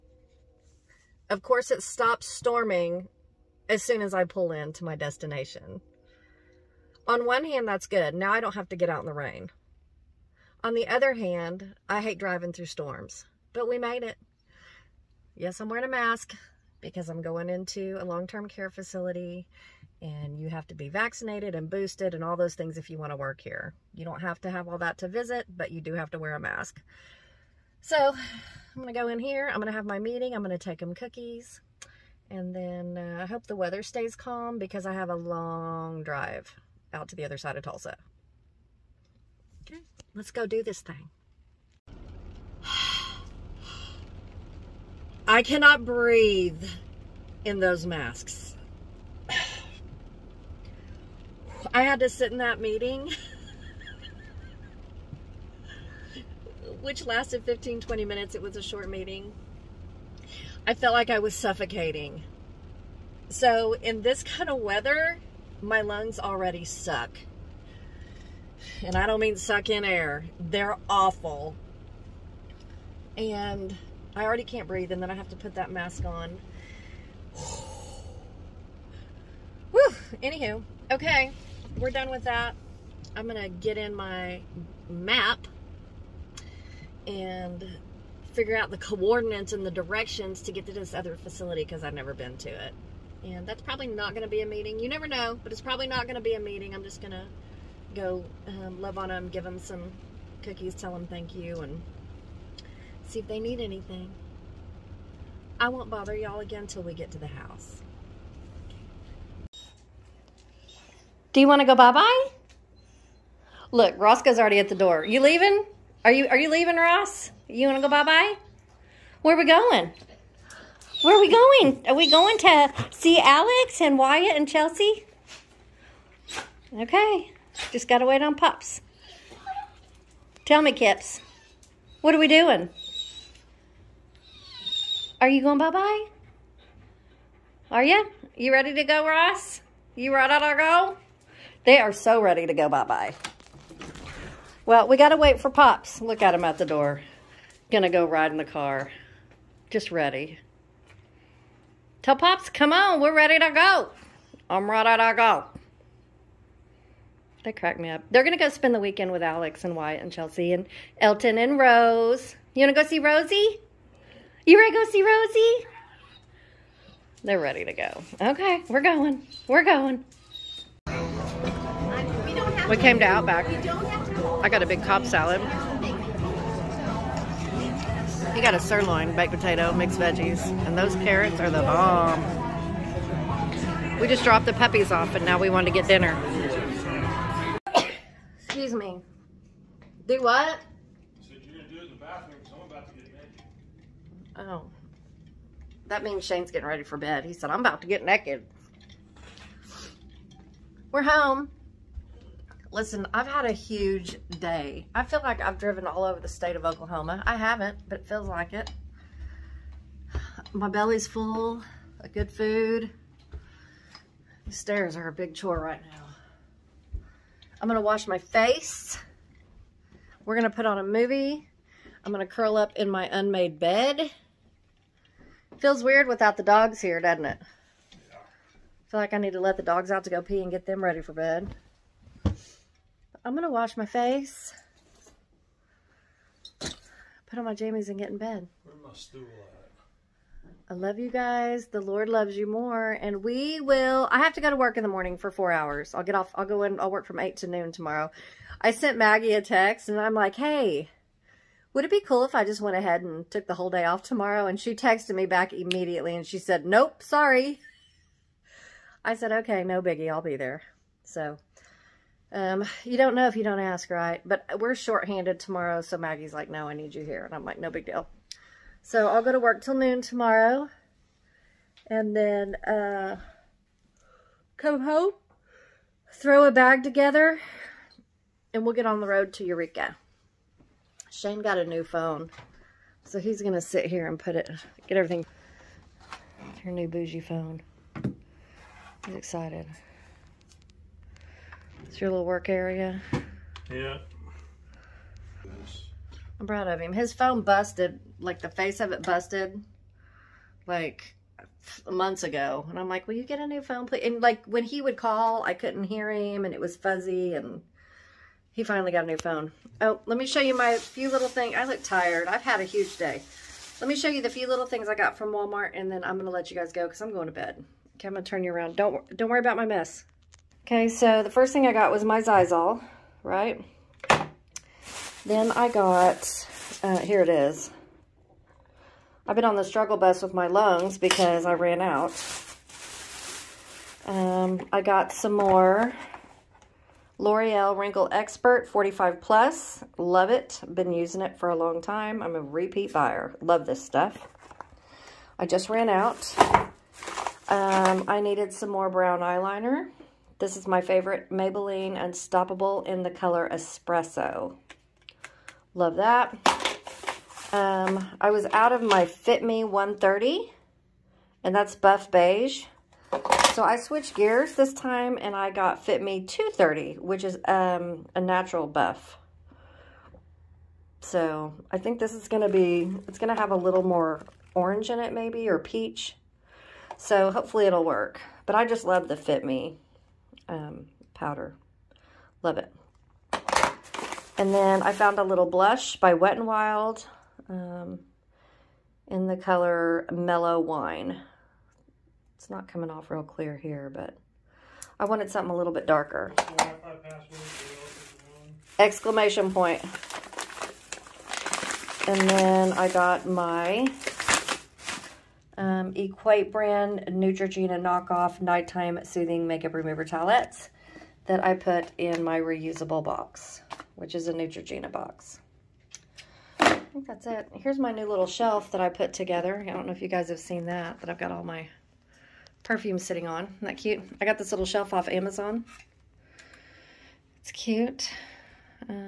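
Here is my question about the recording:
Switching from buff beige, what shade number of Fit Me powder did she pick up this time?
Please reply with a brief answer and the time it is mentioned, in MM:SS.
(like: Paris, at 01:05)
230, at 06:05.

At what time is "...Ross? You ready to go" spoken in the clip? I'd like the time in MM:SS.
02:19.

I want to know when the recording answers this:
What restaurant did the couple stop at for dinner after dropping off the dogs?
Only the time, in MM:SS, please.
02:53.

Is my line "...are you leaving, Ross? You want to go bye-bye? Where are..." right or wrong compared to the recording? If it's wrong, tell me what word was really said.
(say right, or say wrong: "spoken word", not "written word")
right.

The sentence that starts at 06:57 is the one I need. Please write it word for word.
Here's my new little shelf that I put together.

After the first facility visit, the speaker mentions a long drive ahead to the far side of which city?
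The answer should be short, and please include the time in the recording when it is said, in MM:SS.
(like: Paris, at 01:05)
Tulsa, at 00:37.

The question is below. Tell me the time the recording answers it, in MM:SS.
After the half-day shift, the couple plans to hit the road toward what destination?
04:39.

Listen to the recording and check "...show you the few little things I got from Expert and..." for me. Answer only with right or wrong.
wrong.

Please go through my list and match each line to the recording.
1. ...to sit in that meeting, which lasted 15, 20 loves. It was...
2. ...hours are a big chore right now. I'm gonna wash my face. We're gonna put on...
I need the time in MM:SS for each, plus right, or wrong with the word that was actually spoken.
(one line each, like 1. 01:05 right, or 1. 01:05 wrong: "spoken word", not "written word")
1. 00:51 wrong: "minutes", not "loves"
2. 03:34 wrong: "stairs", not "hours".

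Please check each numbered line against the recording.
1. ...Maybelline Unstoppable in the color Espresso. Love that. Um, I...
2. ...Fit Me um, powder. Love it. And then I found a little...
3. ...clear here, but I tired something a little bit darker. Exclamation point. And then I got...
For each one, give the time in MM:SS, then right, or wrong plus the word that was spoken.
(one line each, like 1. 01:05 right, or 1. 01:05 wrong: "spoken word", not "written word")
1. 05:51 right
2. 06:19 right
3. 06:33 wrong: "wanted", not "tired".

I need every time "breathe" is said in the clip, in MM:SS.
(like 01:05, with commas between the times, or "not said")
00:45, 01:14.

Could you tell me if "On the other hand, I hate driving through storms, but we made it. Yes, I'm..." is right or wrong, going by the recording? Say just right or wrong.
right.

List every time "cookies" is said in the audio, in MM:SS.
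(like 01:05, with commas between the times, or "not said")
00:30, 01:40.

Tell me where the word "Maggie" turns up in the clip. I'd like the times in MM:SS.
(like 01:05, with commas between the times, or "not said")
04:08, 04:25.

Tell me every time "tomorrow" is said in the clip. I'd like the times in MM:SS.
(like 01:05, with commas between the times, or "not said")
04:07, 04:14, 04:25, 04:30.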